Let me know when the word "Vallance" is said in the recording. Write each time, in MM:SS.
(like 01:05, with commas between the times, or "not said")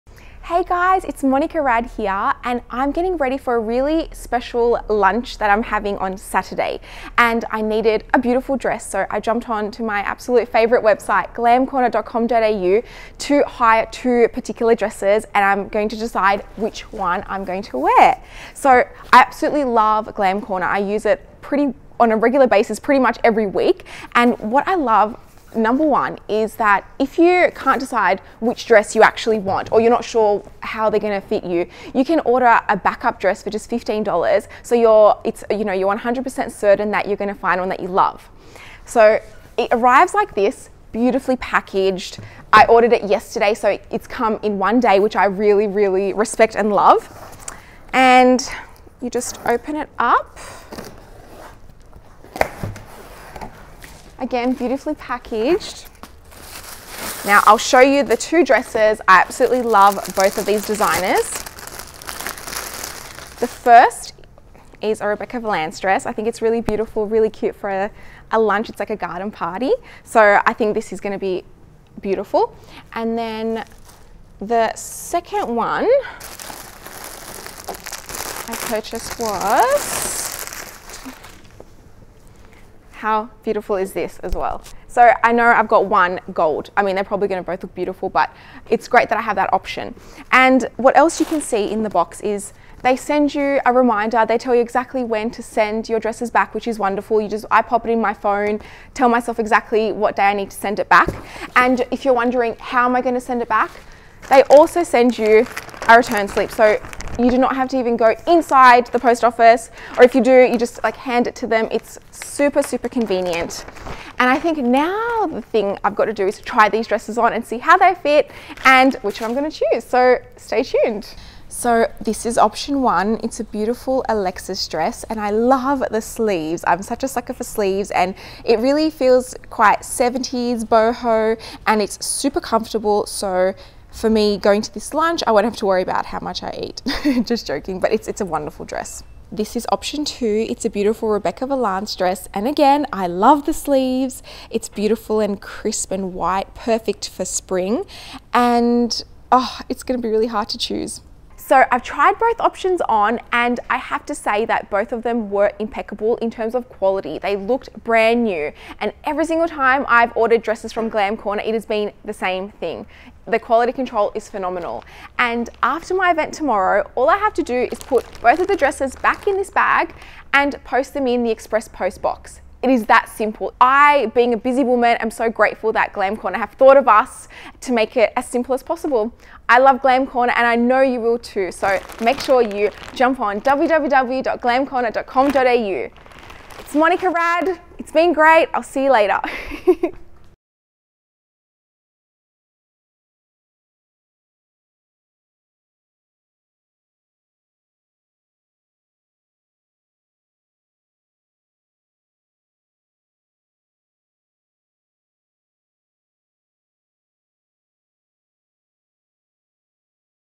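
01:05, 02:21.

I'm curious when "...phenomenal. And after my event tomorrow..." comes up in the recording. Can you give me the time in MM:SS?
02:44.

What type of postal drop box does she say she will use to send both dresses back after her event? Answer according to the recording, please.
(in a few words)
express post box.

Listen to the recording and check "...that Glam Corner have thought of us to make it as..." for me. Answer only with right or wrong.
right.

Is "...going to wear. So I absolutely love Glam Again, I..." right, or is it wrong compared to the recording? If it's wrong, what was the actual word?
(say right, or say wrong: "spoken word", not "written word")
wrong: "Corner", not "Again".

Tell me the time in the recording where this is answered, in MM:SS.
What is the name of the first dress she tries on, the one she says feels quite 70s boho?
02:04.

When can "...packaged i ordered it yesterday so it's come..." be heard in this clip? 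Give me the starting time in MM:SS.
00:41.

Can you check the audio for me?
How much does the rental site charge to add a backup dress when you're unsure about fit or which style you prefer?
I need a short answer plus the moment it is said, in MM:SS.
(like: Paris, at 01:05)
$15, at 00:33.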